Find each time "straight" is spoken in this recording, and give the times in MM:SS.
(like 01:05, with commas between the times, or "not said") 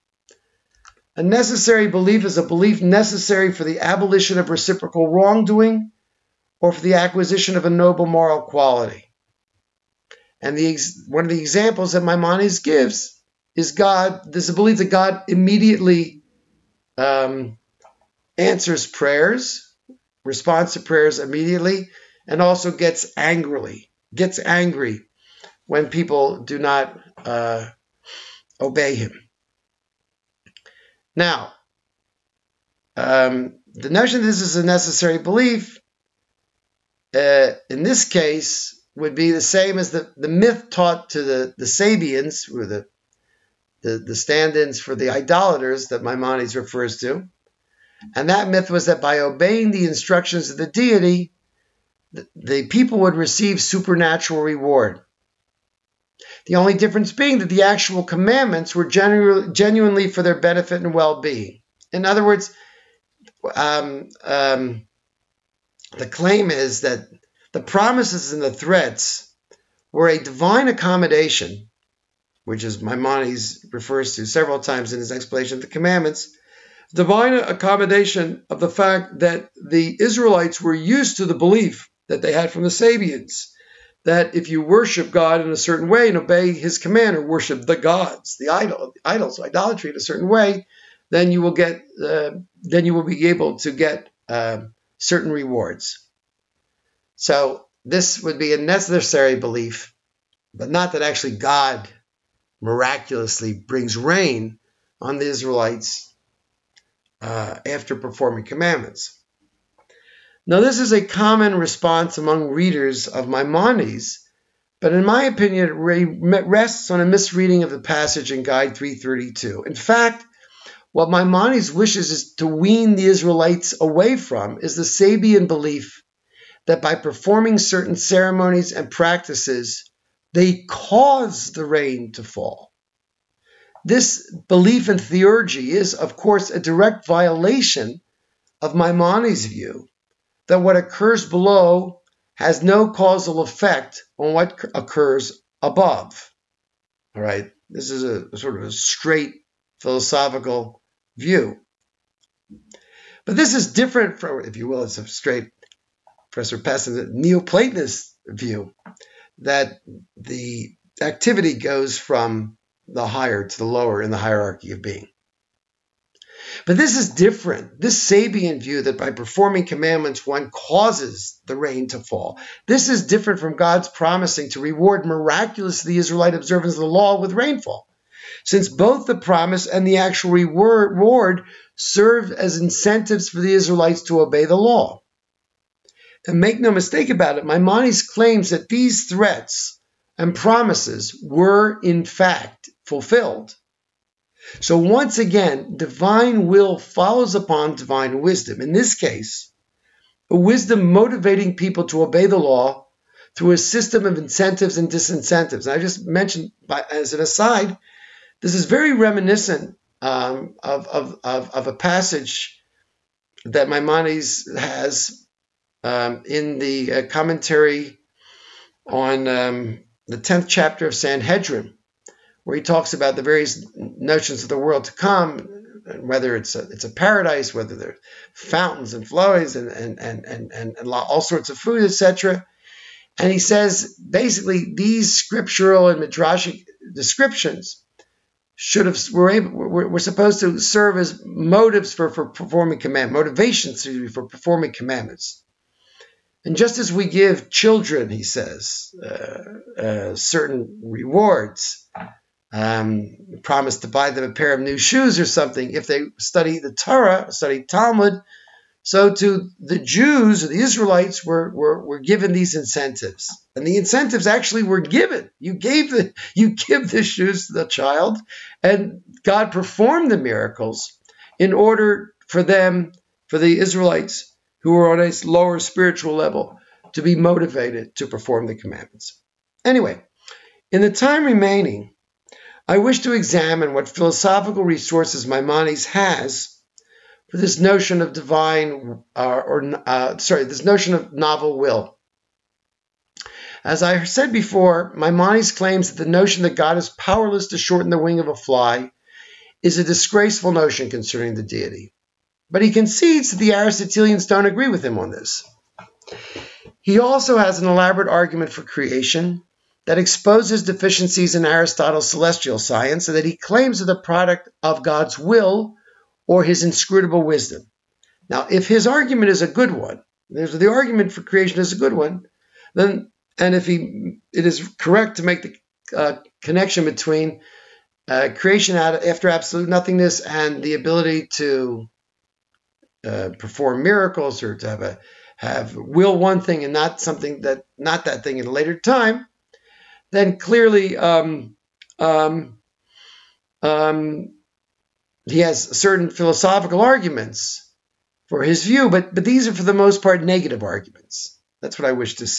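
02:28, 02:35.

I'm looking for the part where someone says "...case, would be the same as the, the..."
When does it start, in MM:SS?
00:38.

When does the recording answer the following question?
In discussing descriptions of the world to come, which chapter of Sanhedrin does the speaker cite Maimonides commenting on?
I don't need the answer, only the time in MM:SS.
03:40.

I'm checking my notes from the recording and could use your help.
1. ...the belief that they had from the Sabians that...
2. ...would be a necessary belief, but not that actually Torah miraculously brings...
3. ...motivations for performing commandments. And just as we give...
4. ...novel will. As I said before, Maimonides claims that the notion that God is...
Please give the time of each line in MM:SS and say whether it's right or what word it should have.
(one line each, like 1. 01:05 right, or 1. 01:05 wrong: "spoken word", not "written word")
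1. 01:21 right
2. 01:38 wrong: "God", not "Torah"
3. 04:03 right
4. 04:51 right.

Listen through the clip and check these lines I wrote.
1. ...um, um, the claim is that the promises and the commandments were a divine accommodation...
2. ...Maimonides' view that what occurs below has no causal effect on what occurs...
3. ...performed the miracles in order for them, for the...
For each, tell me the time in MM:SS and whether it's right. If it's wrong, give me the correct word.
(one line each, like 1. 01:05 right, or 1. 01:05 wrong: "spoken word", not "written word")
1. 01:03 wrong: "threats", not "commandments"
2. 02:18 right
3. 04:29 right.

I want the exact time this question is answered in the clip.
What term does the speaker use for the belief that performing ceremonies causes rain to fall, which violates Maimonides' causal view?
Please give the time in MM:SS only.
02:14.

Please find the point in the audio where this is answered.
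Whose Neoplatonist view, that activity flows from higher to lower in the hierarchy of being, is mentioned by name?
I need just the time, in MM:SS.
02:36.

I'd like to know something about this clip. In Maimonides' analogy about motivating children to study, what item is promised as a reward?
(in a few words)
a pair of new shoes.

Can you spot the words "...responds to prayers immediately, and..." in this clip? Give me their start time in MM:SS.
00:20.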